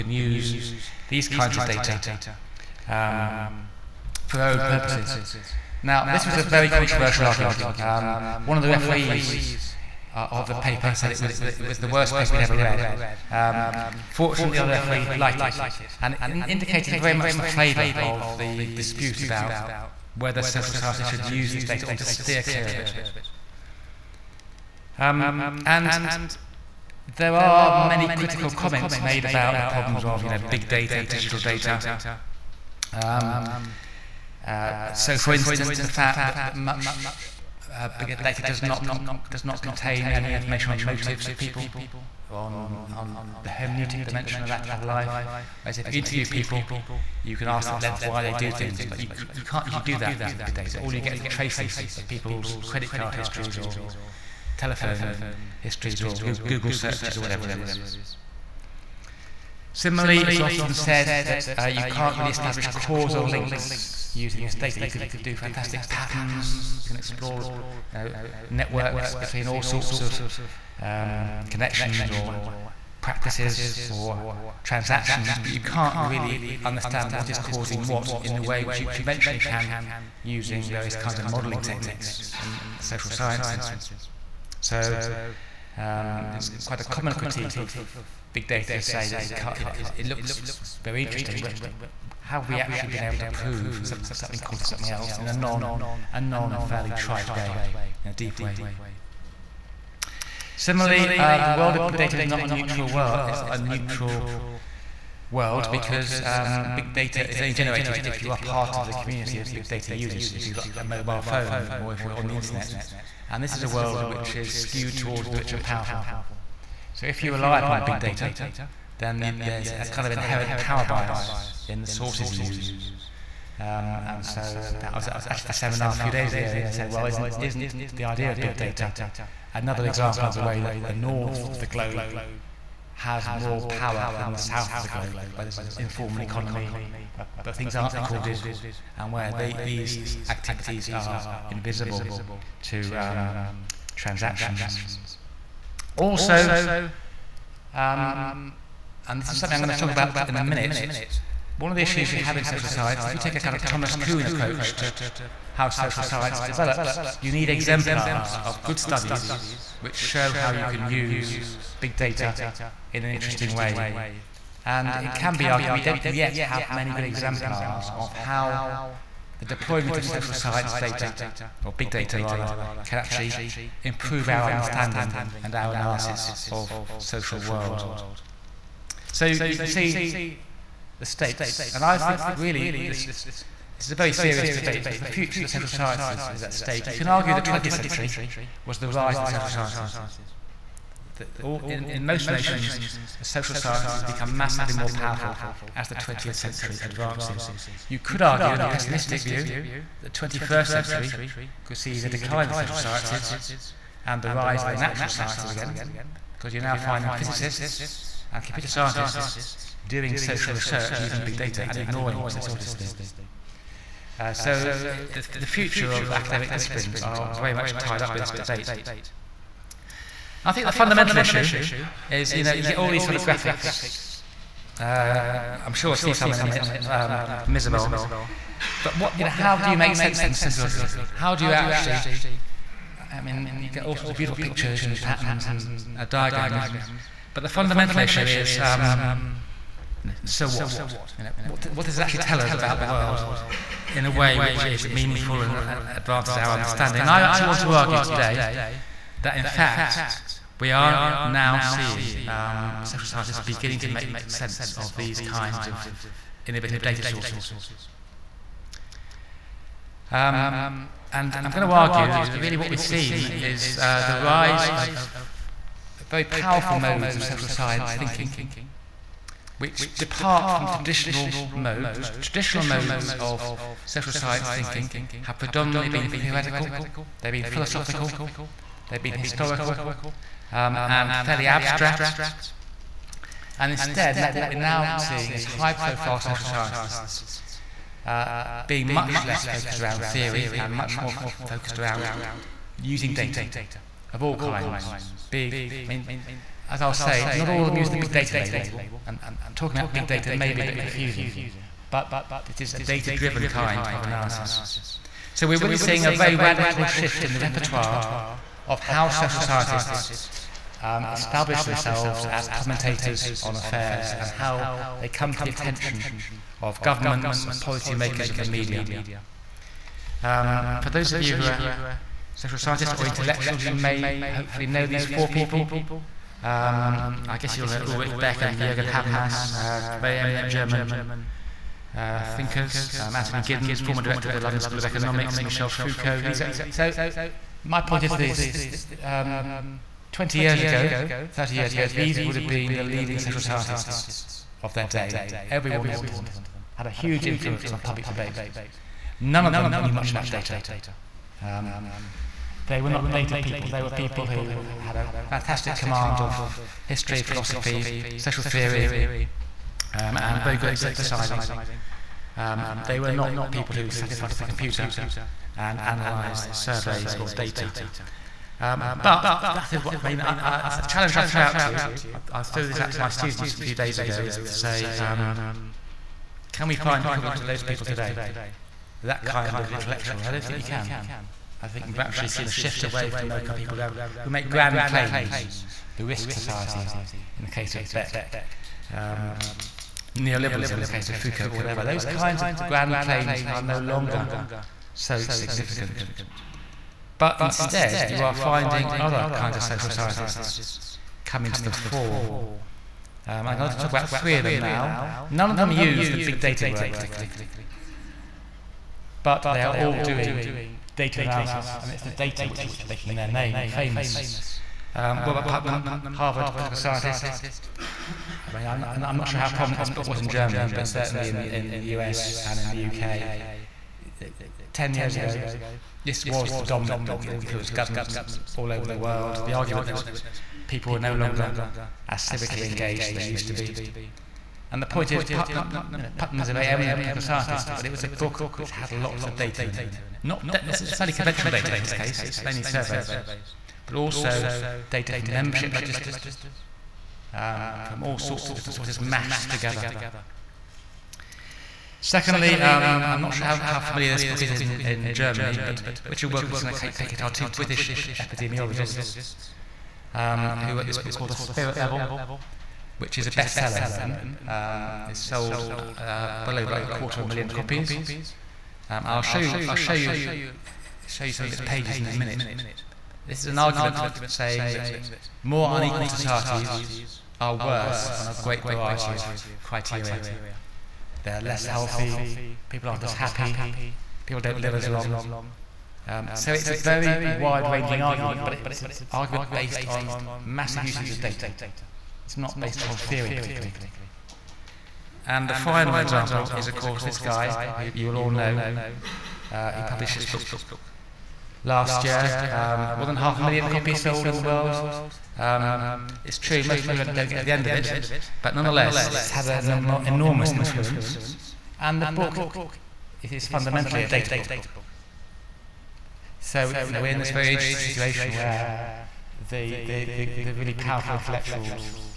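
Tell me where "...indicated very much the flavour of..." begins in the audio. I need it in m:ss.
0:16.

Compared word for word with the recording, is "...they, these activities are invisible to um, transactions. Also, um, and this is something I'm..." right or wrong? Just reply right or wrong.
right.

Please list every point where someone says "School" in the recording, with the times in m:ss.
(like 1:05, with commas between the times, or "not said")
5:34.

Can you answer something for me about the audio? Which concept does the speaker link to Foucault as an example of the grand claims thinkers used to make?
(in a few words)
neoliberalism.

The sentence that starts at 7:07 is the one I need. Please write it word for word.
It influenced governments all over the world.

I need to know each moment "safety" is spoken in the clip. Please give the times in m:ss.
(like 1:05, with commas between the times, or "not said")
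not said.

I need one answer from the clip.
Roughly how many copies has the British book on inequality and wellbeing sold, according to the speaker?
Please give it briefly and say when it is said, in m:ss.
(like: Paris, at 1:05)
over a quarter of a million, at 7:46.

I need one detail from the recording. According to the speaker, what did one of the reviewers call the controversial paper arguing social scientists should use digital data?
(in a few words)
the worst paper he'd ever read.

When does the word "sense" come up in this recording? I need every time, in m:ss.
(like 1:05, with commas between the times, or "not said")
3:49, 4:14.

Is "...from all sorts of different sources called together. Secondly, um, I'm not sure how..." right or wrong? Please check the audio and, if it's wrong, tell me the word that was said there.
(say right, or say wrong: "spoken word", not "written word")
wrong: "mashed", not "called".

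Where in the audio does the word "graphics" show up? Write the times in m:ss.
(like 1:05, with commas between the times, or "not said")
3:43.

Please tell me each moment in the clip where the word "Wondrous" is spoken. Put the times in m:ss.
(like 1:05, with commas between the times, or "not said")
not said.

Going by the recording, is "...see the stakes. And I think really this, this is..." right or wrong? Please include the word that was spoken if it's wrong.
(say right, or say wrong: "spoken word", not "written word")
right.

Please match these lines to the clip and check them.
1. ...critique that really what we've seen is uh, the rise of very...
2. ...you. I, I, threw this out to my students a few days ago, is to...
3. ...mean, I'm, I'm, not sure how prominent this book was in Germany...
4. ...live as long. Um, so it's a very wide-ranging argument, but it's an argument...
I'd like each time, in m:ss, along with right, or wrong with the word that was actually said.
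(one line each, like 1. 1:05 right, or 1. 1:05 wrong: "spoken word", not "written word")
1. 4:21 wrong: "argue", not "critique"
2. 6:11 right
3. 6:58 right
4. 8:04 right.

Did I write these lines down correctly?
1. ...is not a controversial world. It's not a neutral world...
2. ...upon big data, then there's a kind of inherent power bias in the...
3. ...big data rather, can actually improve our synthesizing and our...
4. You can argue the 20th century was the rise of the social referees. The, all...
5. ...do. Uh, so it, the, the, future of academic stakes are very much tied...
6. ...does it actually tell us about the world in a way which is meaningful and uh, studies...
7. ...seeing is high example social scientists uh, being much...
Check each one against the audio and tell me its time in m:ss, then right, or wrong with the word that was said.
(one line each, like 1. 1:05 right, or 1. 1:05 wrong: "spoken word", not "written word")
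1. 1:42 wrong: "neutral", not "controversial"
2. 1:57 right
3. 2:51 wrong: "understanding", not "synthesizing"
4. 3:06 wrong: "sciences", not "referees"
5. 3:32 wrong: "disciplines", not "stakes"
6. 4:01 wrong: "advances", not "studies"
7. 4:44 wrong: "profile", not "example".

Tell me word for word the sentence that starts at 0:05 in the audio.
Now, this was a very controversial argument.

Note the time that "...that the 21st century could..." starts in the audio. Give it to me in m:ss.
3:20.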